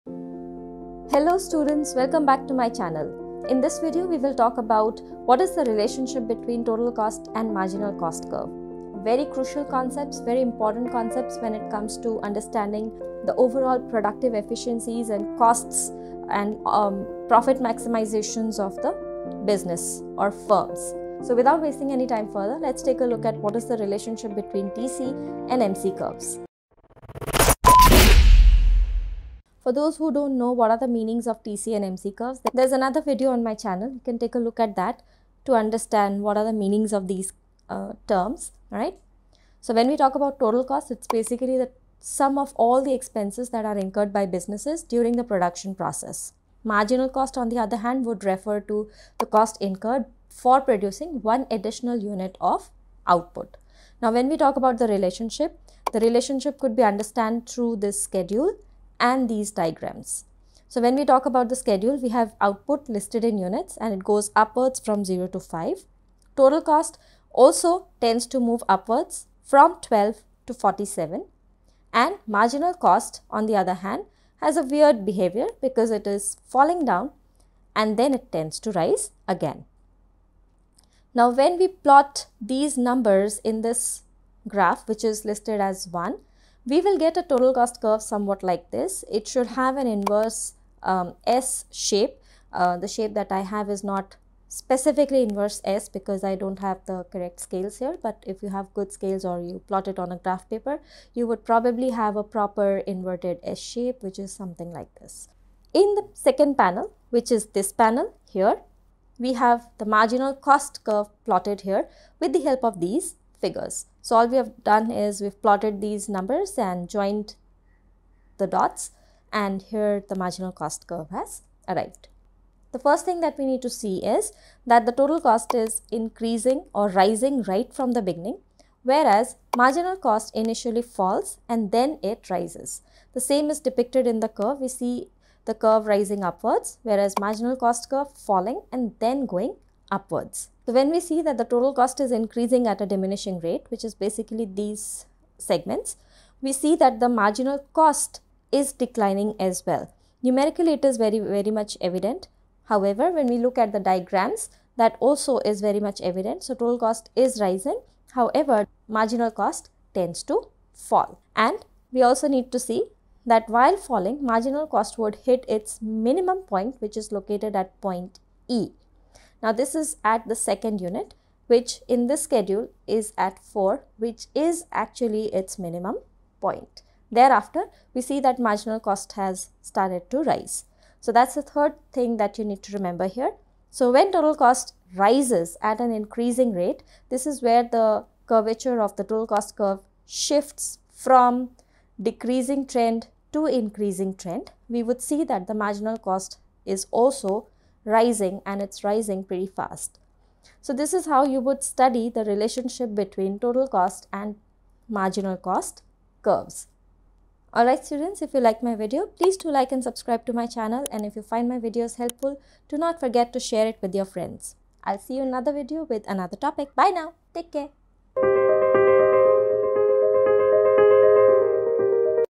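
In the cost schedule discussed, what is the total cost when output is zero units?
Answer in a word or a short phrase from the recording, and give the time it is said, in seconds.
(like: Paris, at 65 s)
12, at 69 s.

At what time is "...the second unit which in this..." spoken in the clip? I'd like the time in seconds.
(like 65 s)
170 s.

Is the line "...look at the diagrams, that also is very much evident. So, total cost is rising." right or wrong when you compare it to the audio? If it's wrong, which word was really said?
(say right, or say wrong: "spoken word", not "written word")
right.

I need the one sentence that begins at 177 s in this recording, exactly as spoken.
Thereafter we see that marginal cost has started to rise.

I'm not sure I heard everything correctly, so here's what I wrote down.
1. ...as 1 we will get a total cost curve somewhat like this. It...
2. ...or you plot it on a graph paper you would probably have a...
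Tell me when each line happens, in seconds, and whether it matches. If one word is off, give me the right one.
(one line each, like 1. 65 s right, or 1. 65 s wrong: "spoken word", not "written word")
1. 85 s right
2. 99 s right.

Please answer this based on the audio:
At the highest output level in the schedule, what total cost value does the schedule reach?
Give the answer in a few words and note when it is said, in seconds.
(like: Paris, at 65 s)
47, at 70 s.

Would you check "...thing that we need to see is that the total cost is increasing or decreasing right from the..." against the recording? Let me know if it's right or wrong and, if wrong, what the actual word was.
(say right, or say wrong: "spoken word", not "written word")
wrong: "rising", not "decreasing".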